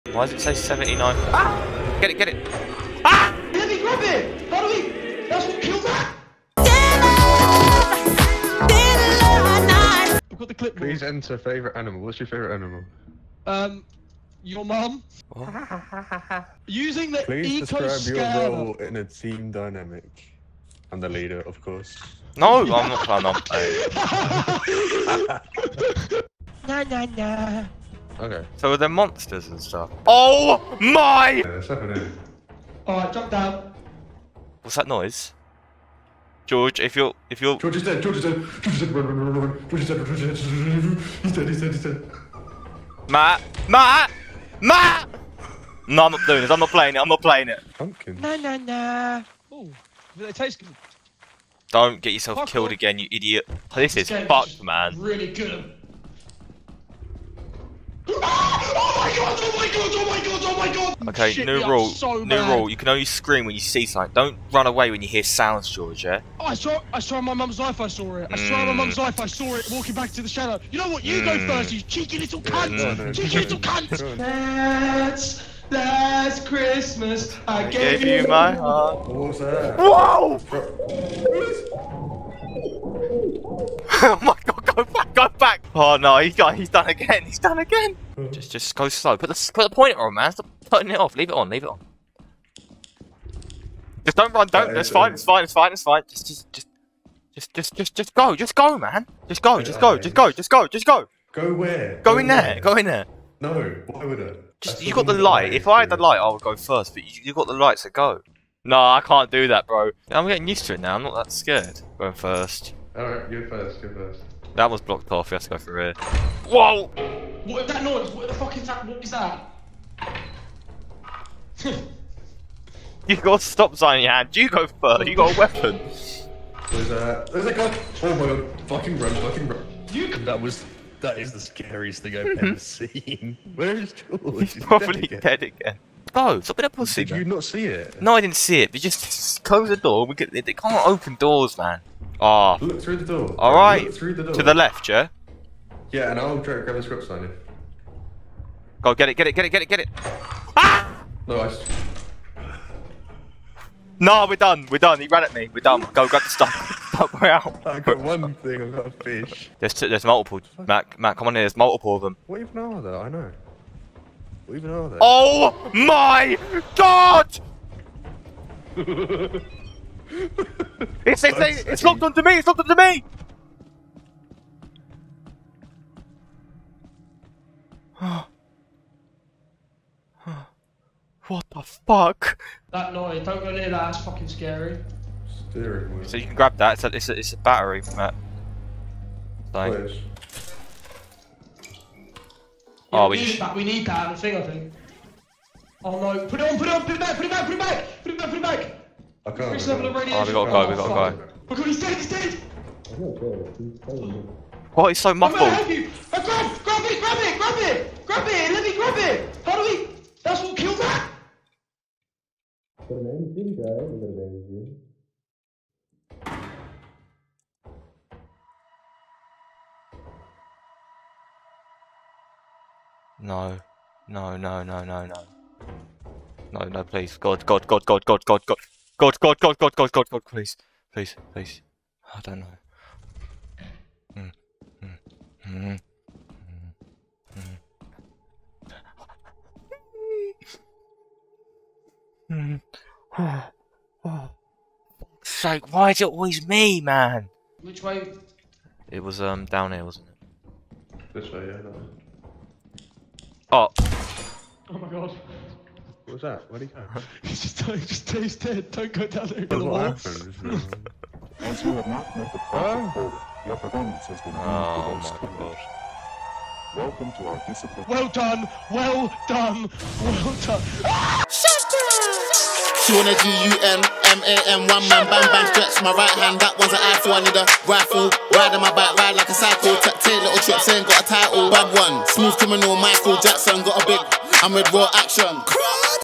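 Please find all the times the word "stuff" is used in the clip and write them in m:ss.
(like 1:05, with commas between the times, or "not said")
0:29, 2:36.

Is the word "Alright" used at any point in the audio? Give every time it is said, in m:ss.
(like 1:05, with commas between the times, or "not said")
0:32, 1:52.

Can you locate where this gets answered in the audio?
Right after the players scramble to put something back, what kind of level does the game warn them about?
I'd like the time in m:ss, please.
3:19.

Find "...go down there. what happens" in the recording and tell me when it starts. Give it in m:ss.
4:18.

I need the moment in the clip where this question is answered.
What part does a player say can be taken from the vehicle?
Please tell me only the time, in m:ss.
3:07.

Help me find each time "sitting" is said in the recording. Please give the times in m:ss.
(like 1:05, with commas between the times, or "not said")
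not said.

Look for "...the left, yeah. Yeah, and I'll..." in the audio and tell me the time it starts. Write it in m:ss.
2:24.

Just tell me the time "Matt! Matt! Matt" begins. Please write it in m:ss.
0:43.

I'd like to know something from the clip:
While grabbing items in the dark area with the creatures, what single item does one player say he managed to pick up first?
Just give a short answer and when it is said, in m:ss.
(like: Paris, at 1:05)
A fish, at 2:38.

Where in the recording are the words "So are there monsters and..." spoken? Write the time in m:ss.
0:28.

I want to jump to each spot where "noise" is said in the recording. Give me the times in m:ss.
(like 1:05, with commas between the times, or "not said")
0:34, 1:57, 3:02.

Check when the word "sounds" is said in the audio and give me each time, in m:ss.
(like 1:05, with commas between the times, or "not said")
1:05.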